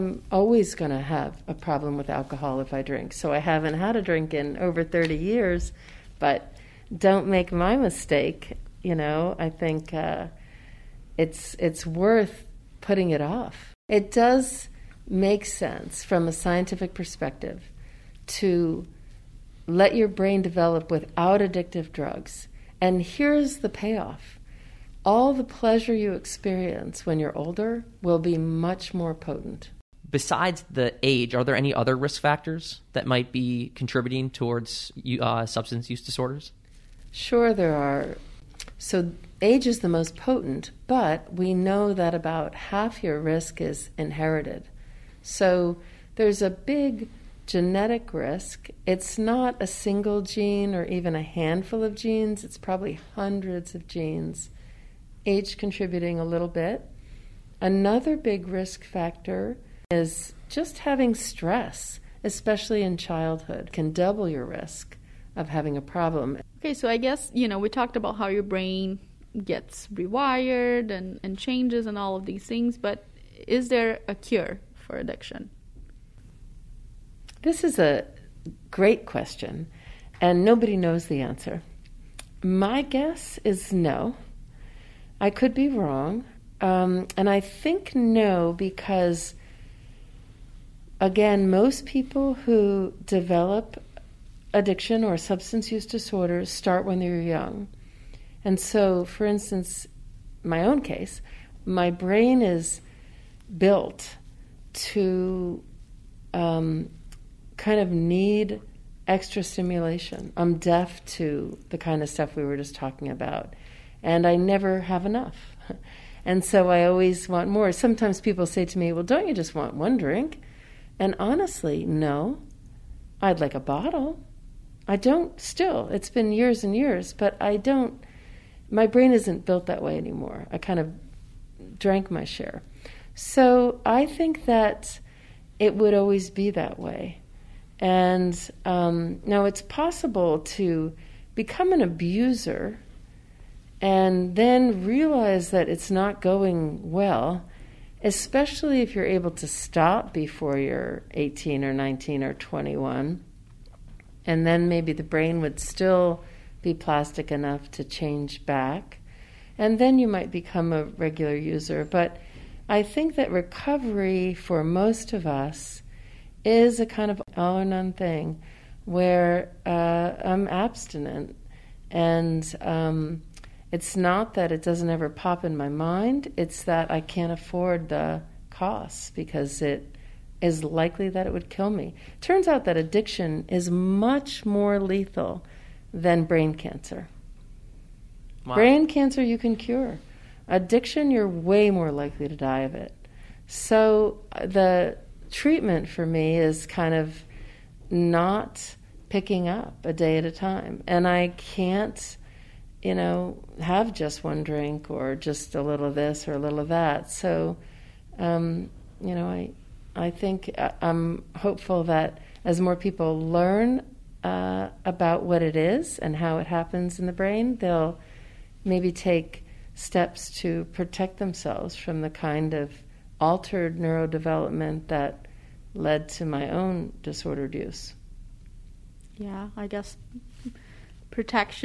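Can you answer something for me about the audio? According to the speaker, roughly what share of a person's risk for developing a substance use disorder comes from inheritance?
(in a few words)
About half.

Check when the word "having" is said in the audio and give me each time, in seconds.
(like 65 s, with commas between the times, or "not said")
60 s, 65 s.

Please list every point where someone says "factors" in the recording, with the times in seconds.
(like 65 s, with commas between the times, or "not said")
32 s, 58 s.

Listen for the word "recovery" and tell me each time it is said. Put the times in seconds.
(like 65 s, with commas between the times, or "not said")
163 s.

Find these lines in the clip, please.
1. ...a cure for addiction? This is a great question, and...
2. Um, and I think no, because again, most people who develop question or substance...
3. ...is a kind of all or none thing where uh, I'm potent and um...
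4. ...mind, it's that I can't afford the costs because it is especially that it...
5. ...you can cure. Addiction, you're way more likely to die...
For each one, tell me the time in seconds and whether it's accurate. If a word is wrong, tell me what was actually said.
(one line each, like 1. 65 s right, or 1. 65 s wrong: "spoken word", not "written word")
1. 74 s right
2. 86 s wrong: "addiction", not "question"
3. 166 s wrong: "abstinent", not "potent"
4. 175 s wrong: "likely", not "especially"
5. 189 s right.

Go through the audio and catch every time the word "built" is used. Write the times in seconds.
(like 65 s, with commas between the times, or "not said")
103 s, 129 s.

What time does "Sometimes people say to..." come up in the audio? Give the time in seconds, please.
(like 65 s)
117 s.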